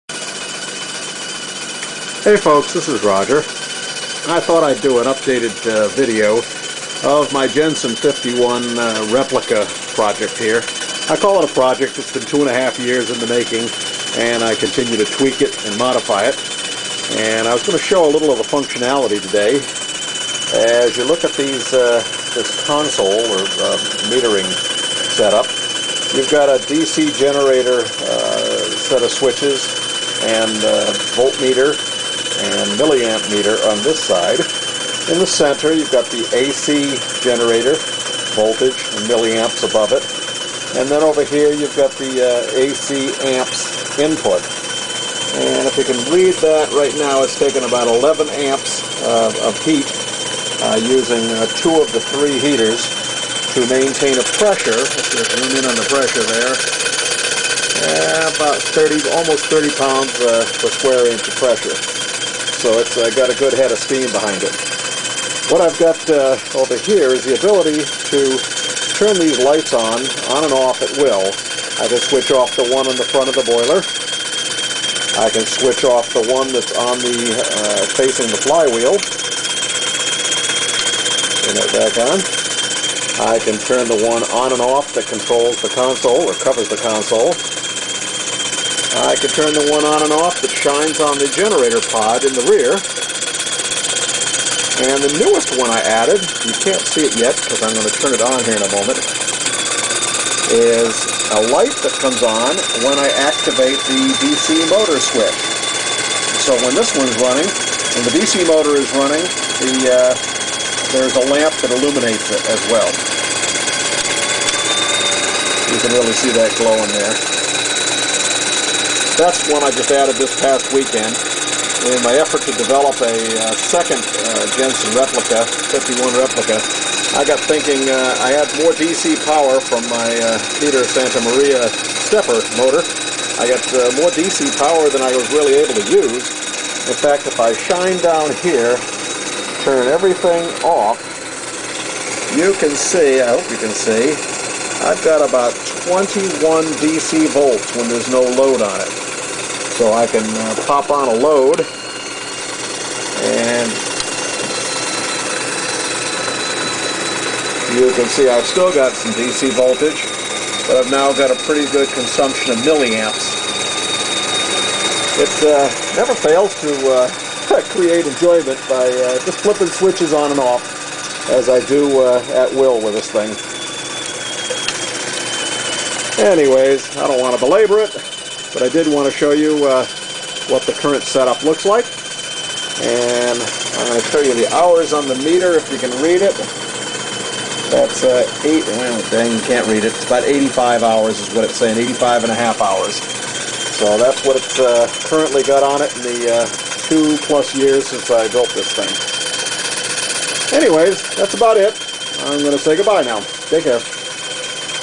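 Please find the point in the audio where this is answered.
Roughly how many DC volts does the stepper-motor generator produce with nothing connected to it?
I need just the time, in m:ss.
2:25.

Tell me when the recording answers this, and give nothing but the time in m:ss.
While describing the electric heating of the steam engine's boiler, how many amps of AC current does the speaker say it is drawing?
0:47.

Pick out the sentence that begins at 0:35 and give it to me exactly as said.
In the center, you've got the AC generator, voltage, and milliamps above it.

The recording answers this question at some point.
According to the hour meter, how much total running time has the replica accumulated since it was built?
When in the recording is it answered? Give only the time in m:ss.
3:11.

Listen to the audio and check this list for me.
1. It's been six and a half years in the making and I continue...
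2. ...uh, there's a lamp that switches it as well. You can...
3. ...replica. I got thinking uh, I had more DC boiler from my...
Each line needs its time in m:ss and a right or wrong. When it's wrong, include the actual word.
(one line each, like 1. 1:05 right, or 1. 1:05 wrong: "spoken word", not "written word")
1. 0:11 wrong: "two", not "six"
2. 1:49 wrong: "illuminates", not "switches"
3. 2:06 wrong: "power", not "boiler".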